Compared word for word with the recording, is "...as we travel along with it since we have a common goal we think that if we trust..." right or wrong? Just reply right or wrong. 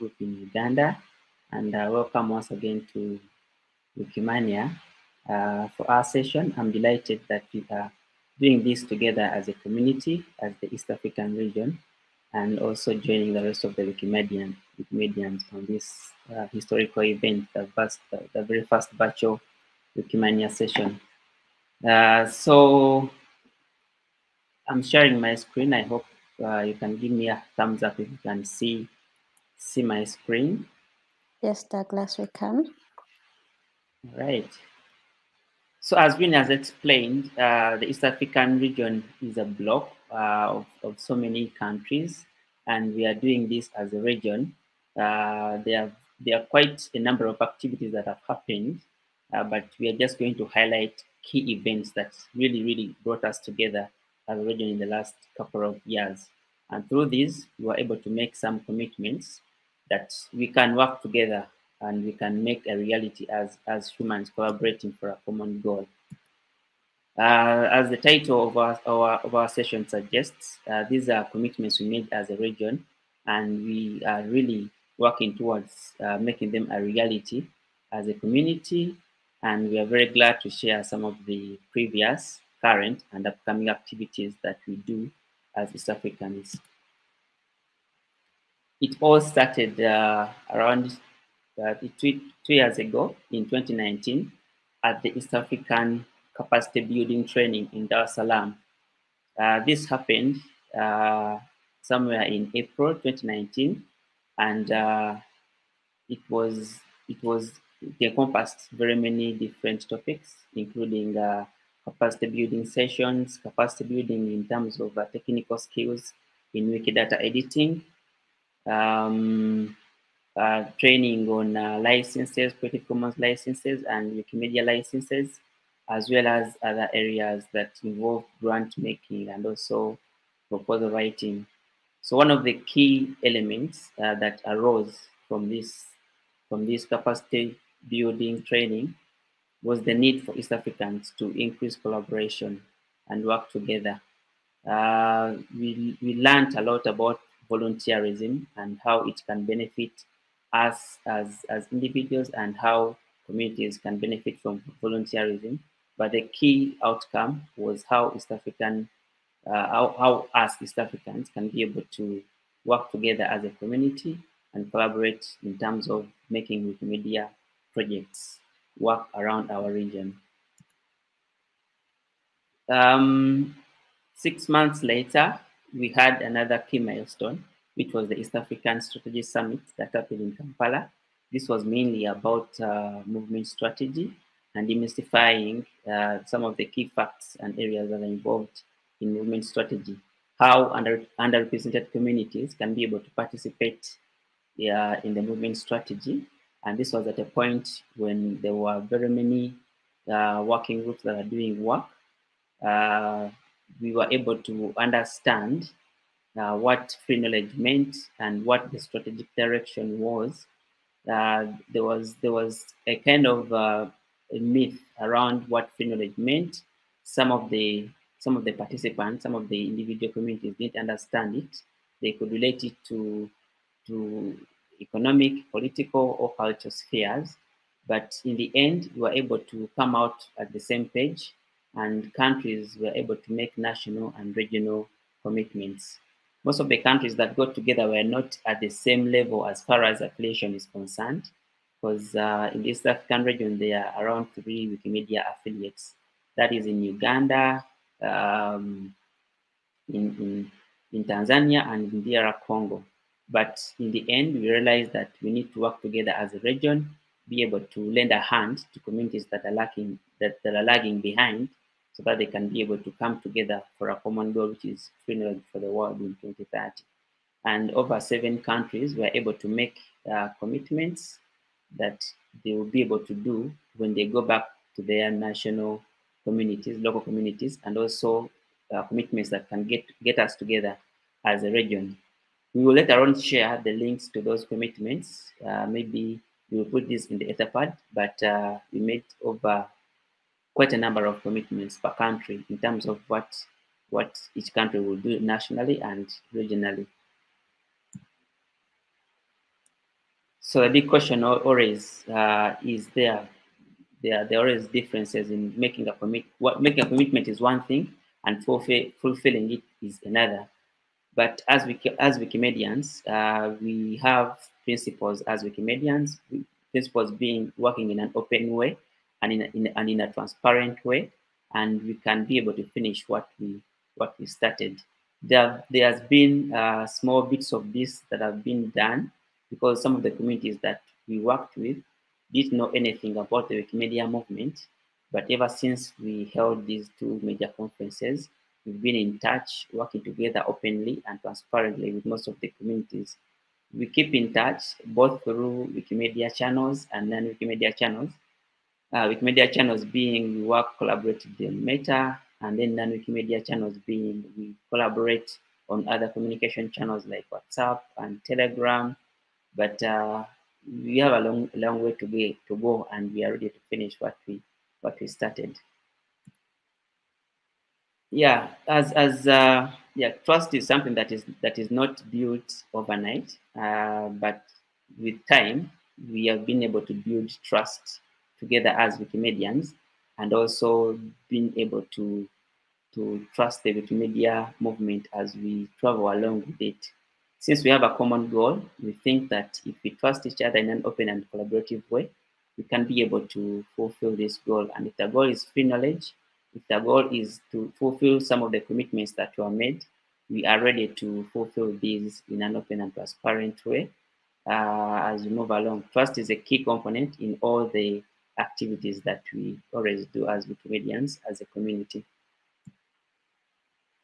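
right.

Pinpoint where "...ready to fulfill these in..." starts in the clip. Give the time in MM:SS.
06:40.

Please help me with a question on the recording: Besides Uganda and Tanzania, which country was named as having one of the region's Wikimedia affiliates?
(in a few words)
DR Congo.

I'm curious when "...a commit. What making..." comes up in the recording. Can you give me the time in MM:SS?
05:05.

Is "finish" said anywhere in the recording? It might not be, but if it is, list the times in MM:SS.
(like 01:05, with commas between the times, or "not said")
05:22, 06:03.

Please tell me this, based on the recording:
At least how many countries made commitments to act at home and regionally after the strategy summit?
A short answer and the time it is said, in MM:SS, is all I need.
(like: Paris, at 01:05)
Over 7, at 04:27.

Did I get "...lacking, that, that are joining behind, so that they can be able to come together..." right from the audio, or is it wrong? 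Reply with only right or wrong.
wrong.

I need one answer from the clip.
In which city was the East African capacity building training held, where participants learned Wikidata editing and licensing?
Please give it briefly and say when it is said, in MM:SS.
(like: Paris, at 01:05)
Dar es Salaam, at 01:37.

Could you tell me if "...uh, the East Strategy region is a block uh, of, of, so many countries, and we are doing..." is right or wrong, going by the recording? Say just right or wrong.
wrong.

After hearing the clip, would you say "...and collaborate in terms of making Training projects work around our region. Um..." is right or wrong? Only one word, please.
wrong.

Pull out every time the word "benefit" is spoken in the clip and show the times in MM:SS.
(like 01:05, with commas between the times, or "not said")
02:29, 02:33.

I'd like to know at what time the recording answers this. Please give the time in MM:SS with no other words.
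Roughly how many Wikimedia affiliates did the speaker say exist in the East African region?
04:04.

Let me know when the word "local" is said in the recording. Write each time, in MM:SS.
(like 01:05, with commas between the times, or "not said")
04:36.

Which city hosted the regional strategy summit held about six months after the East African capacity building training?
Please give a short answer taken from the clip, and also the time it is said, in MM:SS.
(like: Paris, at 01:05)
Kampala, at 03:00.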